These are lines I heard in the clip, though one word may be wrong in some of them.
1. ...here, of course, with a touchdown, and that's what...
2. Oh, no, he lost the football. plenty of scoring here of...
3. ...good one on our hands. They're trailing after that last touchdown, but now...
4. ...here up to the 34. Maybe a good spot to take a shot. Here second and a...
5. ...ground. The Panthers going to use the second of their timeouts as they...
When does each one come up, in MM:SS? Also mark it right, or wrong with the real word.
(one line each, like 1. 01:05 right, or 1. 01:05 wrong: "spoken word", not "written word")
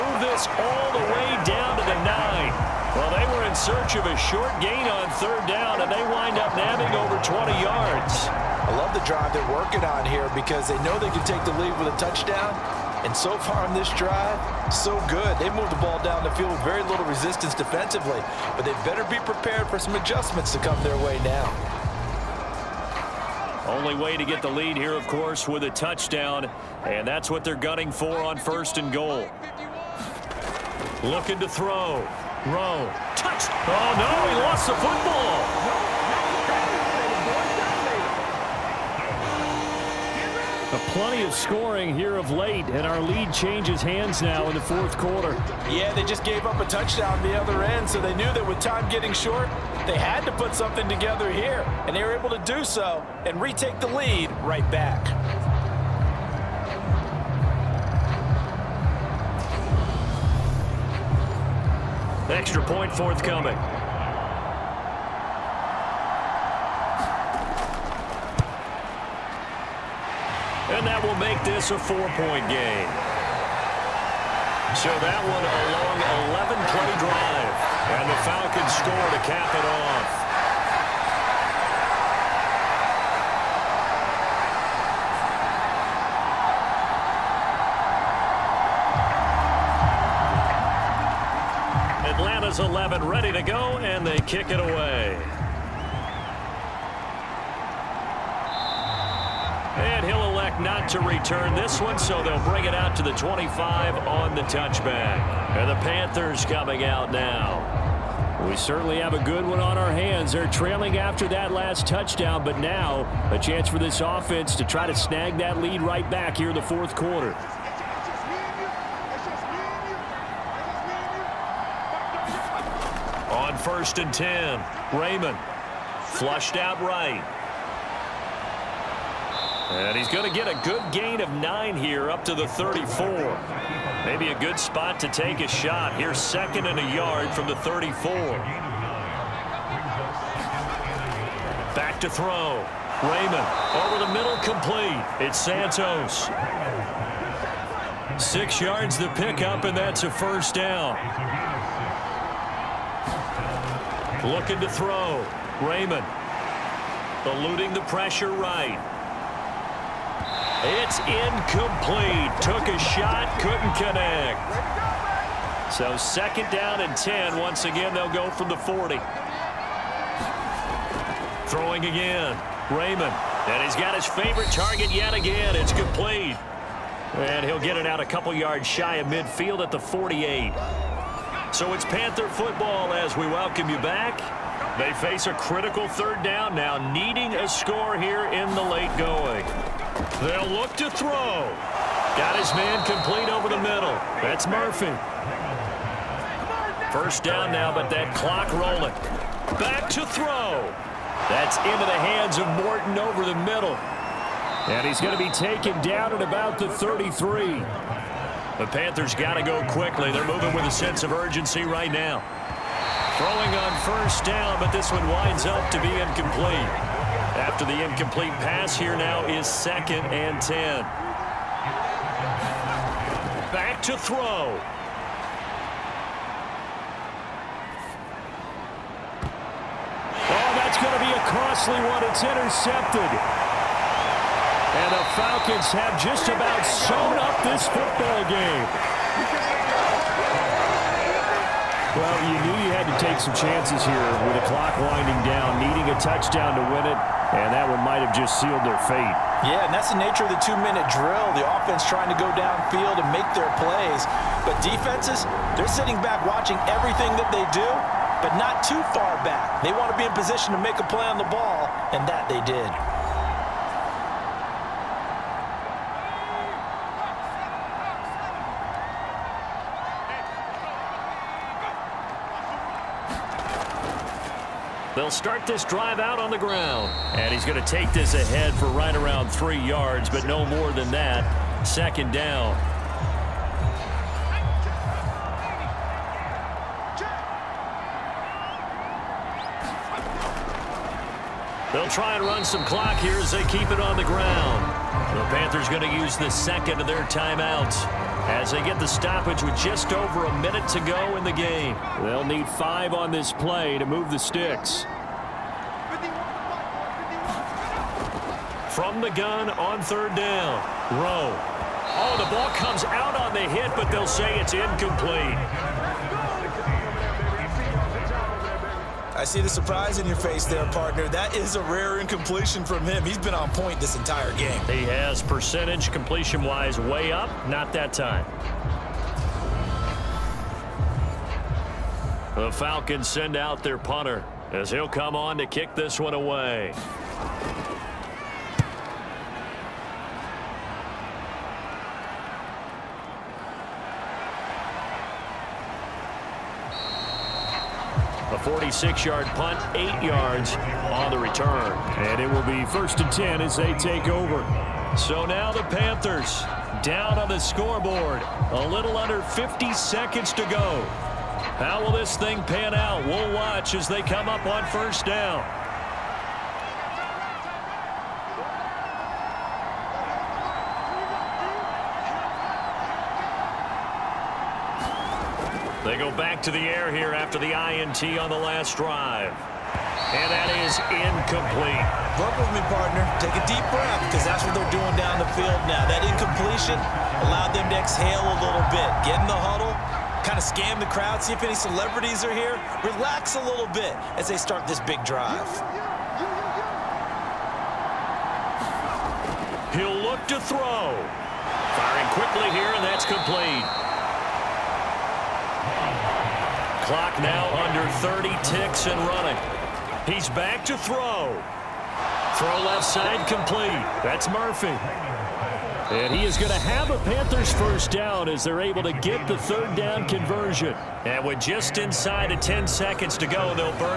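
1. 00:24 right
2. 00:33 right
3. 01:49 right
4. 02:11 right
5. 04:54 right.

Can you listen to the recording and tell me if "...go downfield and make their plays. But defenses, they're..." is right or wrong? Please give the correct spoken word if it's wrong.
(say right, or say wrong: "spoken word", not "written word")
right.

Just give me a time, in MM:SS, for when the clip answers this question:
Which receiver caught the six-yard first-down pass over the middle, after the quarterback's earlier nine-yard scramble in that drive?
02:25.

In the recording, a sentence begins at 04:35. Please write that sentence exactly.
They'll start this drive out on the ground.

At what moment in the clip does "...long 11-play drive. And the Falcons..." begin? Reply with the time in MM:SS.
01:15.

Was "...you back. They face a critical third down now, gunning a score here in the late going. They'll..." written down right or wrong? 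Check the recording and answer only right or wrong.
wrong.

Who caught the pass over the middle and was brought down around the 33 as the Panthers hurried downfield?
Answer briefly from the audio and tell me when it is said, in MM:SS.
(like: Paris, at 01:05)
Morton, at 03:22.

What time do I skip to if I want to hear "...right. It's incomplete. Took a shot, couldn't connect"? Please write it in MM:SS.
02:38.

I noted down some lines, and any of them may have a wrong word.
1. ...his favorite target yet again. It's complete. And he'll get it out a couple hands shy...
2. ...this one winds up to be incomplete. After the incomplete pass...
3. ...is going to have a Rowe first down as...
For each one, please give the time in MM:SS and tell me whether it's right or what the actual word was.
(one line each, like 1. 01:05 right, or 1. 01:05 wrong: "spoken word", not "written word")
1. 02:53 wrong: "yards", not "hands"
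2. 03:34 right
3. 06:56 wrong: "Panthers", not "Rowe".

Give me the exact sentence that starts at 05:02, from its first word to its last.
They'll need five on this play to move the sticks.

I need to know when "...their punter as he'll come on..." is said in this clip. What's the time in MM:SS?
05:33.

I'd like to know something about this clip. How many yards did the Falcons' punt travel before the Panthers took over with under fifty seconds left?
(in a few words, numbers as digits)
46.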